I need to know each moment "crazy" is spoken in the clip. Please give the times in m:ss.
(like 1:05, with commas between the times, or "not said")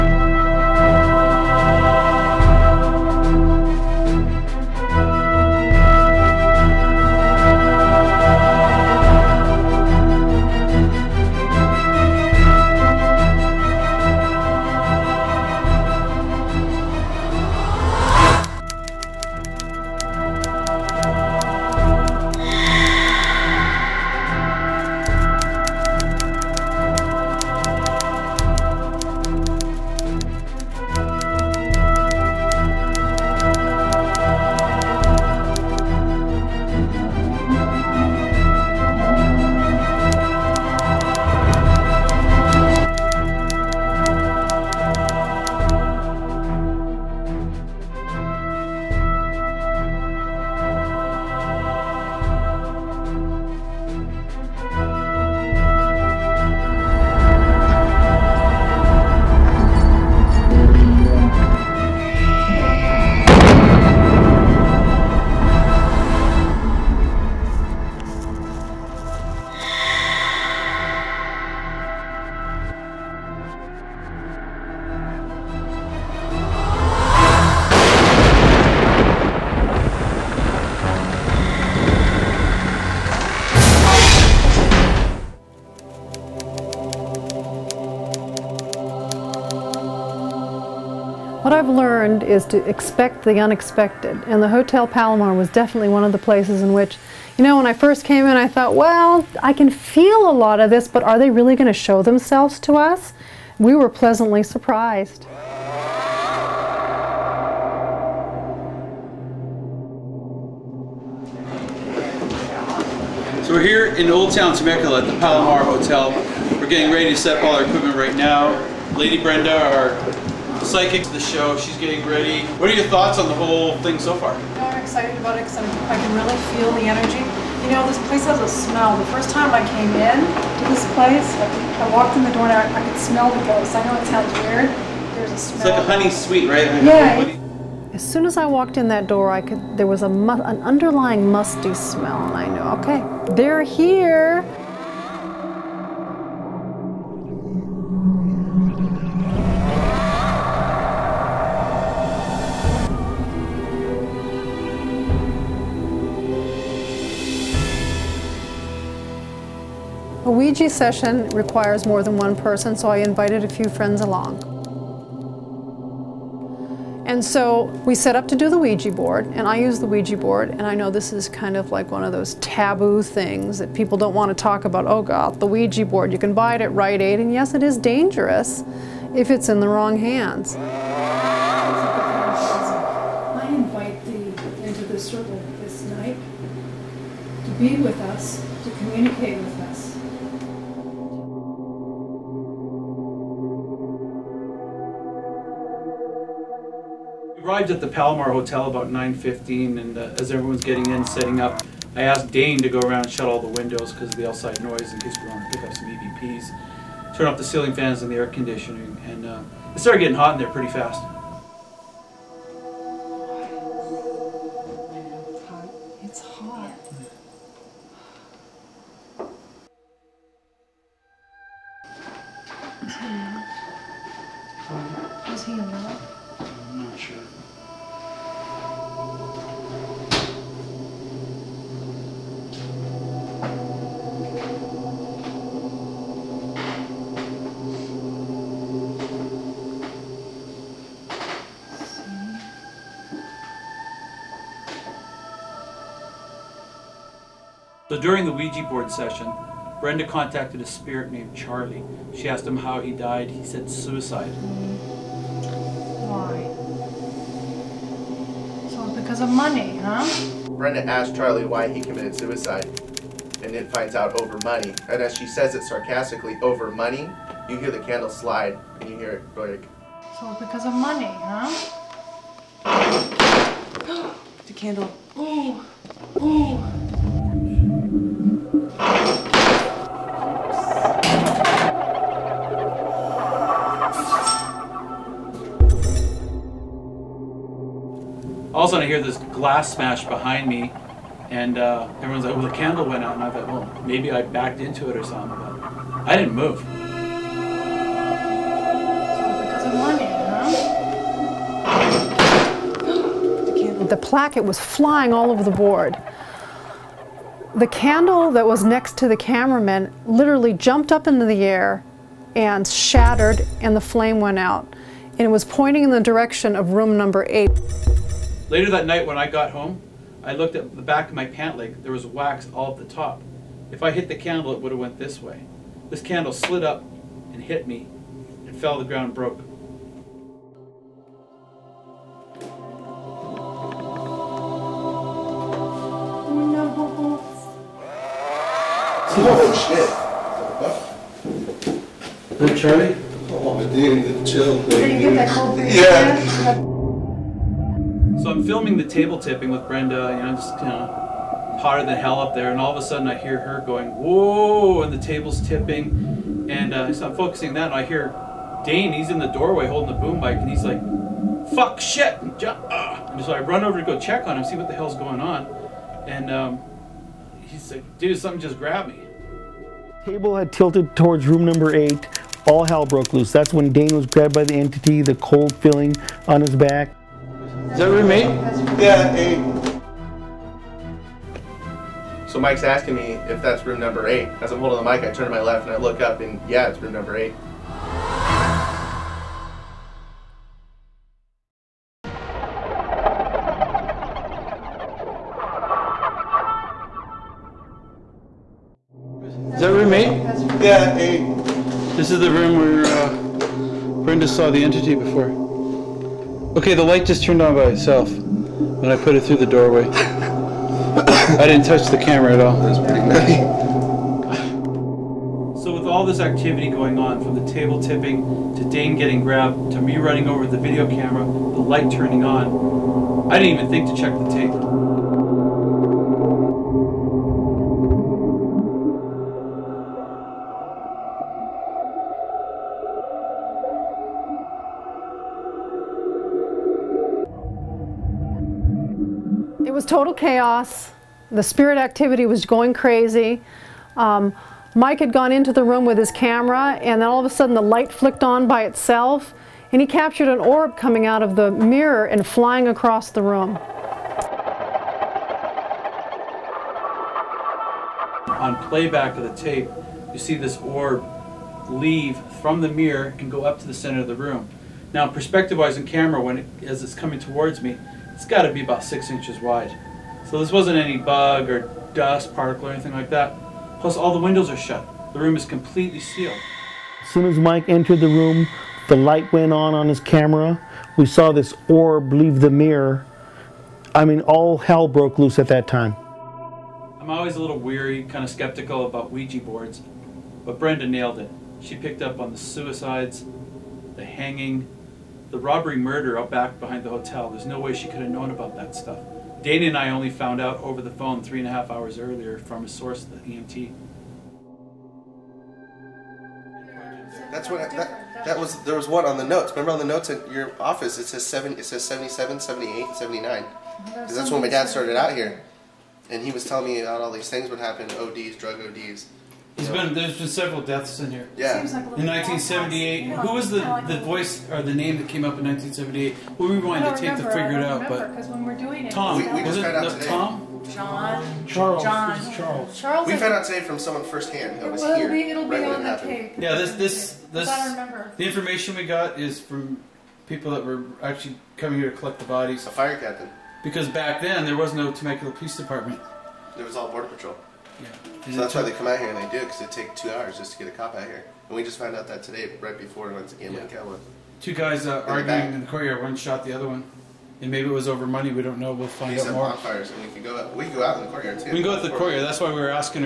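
7:22.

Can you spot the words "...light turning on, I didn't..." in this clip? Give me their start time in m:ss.
7:01.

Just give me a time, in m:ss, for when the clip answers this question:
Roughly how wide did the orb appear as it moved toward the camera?
7:48.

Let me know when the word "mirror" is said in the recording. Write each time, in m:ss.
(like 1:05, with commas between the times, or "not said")
7:31, 7:42, 8:02.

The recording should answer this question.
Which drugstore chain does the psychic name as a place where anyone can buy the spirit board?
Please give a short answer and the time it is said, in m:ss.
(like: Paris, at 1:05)
Rite Aid, at 2:56.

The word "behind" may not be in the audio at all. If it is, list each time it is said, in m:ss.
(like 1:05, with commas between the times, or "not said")
4:50, 8:16.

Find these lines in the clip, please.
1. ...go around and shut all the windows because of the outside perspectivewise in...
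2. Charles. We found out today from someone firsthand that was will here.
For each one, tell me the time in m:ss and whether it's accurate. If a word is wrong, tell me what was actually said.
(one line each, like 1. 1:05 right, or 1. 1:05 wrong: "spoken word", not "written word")
1. 3:22 wrong: "noise", not "perspectivewise"
2. 8:52 right.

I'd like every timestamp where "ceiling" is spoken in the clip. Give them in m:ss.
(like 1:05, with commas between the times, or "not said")
3:27.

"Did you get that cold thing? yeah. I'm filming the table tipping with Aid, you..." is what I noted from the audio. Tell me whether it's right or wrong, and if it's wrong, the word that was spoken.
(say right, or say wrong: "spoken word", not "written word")
wrong: "Brenda", not "Aid".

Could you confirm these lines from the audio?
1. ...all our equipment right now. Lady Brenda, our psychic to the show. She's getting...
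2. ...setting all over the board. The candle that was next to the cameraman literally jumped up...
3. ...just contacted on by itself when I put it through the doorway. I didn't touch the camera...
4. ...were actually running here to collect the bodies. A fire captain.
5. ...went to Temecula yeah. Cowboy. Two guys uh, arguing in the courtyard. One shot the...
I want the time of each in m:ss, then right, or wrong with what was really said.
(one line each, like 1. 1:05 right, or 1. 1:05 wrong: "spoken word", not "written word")
1. 1:57 right
2. 5:04 wrong: "flying", not "setting"
3. 6:47 wrong: "turned", not "contacted"
4. 9:00 wrong: "coming", not "running"
5. 9:13 wrong: "Gambling", not "Temecula".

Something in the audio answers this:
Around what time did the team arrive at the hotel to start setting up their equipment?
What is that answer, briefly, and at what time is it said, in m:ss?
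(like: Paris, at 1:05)
9:15, at 3:18.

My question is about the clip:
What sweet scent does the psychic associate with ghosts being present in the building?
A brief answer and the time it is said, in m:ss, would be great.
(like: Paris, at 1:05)
Honey, at 2:15.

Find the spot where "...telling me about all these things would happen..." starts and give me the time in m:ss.
8:36.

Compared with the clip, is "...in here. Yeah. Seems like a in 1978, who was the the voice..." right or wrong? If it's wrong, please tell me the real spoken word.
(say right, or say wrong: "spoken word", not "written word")
right.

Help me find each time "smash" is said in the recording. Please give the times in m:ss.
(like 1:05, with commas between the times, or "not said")
4:49.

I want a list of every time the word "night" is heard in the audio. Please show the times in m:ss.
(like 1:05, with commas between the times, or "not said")
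3:05, 5:18.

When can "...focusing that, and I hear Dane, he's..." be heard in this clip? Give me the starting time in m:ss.
5:57.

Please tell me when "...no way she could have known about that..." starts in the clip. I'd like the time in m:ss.
8:17.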